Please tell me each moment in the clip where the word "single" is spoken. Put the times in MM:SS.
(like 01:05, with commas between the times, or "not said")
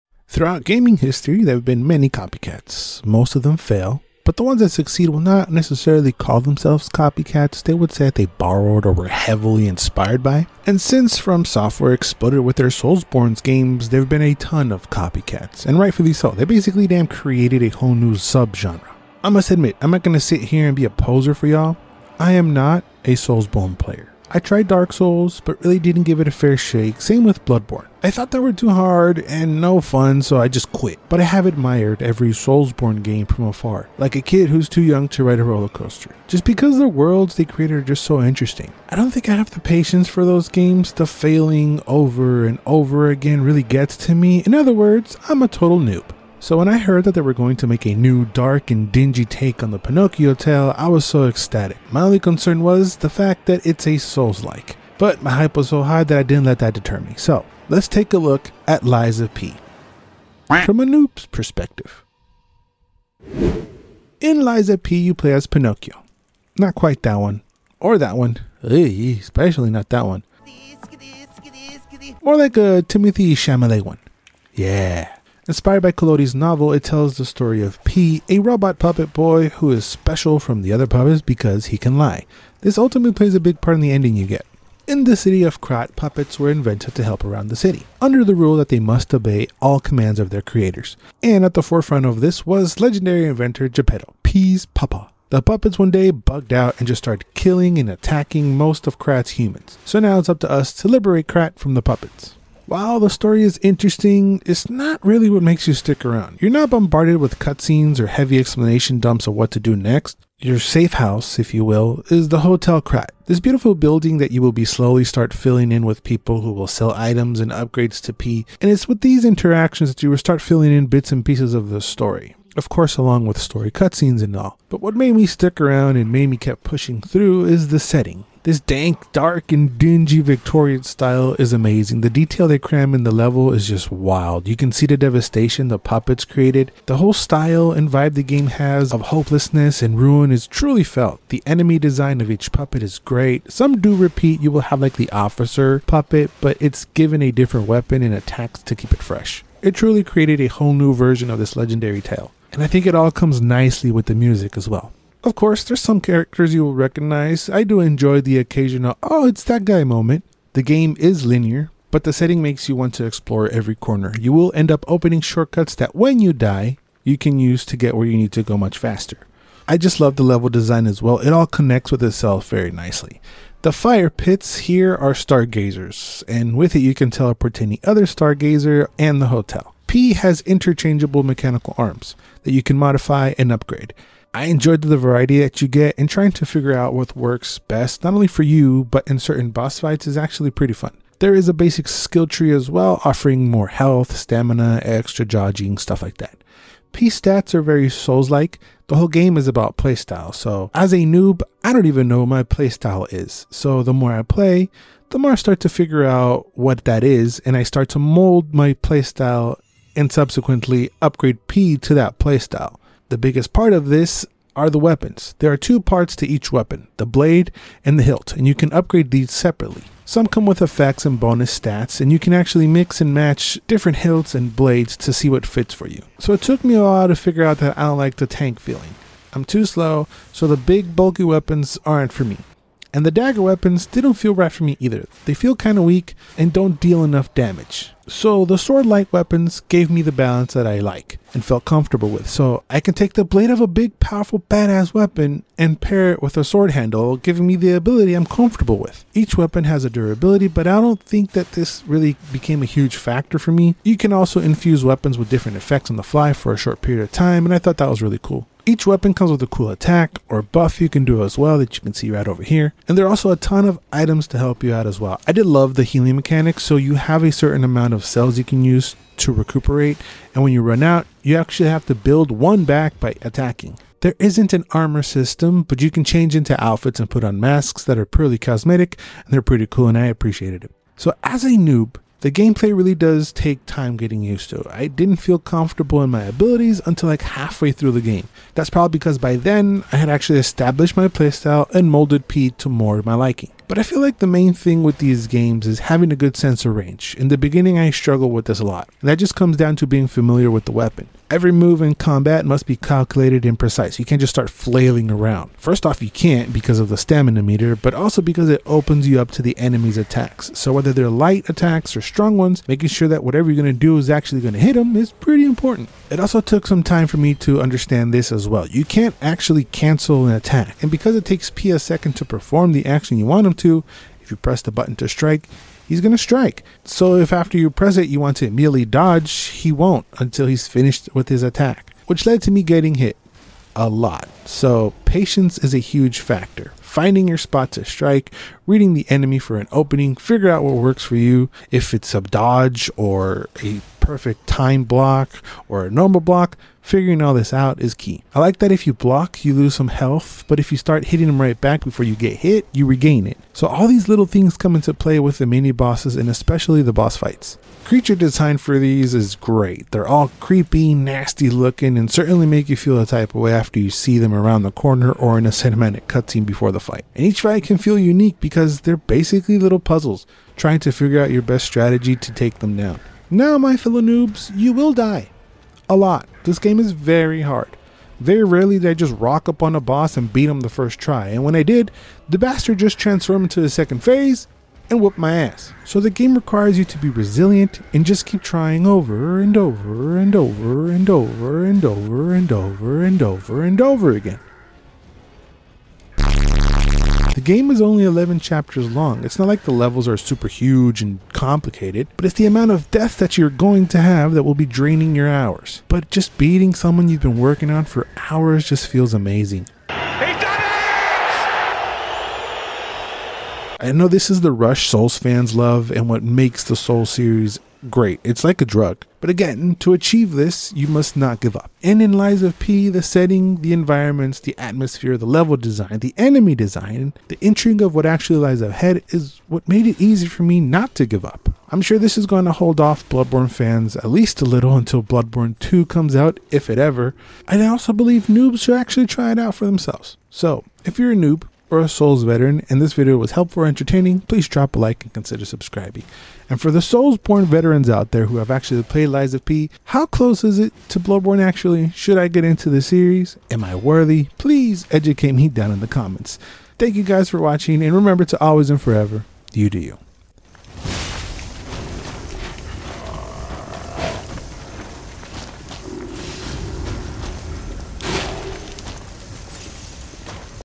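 not said.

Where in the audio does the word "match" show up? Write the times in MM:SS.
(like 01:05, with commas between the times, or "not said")
03:43.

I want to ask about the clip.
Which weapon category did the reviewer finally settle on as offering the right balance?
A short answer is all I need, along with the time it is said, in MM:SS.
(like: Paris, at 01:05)
sword light weapons, at 03:58.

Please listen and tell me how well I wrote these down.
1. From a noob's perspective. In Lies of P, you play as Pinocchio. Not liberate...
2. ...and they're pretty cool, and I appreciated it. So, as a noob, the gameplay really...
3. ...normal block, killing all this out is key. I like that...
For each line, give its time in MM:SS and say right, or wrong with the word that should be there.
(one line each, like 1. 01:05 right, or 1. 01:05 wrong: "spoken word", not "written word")
1. 01:00 wrong: "quite", not "liberate"
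2. 04:39 right
3. 05:45 wrong: "figuring", not "killing".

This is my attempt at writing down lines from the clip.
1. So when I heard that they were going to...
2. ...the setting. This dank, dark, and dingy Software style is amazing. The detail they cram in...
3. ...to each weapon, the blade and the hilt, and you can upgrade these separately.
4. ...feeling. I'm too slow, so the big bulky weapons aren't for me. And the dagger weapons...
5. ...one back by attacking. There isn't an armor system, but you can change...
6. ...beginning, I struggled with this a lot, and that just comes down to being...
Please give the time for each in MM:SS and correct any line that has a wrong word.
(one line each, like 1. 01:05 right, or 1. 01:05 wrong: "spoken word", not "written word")
1. 00:46 right
2. 02:07 wrong: "Victorian", not "Software"
3. 03:36 right
4. 03:48 right
5. 04:32 right
6. 04:57 right.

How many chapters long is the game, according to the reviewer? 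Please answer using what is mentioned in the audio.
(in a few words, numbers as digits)
11.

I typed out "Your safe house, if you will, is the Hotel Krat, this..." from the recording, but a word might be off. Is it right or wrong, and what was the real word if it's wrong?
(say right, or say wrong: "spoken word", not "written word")
right.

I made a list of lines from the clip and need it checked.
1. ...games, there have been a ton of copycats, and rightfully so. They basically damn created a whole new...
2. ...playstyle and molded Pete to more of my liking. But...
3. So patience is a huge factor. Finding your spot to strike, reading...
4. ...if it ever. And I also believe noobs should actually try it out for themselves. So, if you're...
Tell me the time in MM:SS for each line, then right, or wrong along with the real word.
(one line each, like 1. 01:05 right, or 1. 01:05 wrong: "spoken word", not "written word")
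1. 00:13 right
2. 04:51 right
3. 05:34 right
4. 07:16 right.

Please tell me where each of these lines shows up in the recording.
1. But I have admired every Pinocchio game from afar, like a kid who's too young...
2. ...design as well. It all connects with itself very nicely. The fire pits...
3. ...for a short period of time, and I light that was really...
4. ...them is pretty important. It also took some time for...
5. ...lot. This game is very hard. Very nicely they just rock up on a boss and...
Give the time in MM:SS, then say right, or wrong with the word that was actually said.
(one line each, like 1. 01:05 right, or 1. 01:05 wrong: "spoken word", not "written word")
1. 00:31 wrong: "Soulsborne", not "Pinocchio"
2. 02:50 right
3. 04:16 wrong: "thought", not "light"
4. 05:14 right
5. 06:15 wrong: "rarely", not "nicely".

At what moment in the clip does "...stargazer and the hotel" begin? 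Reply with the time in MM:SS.
02:58.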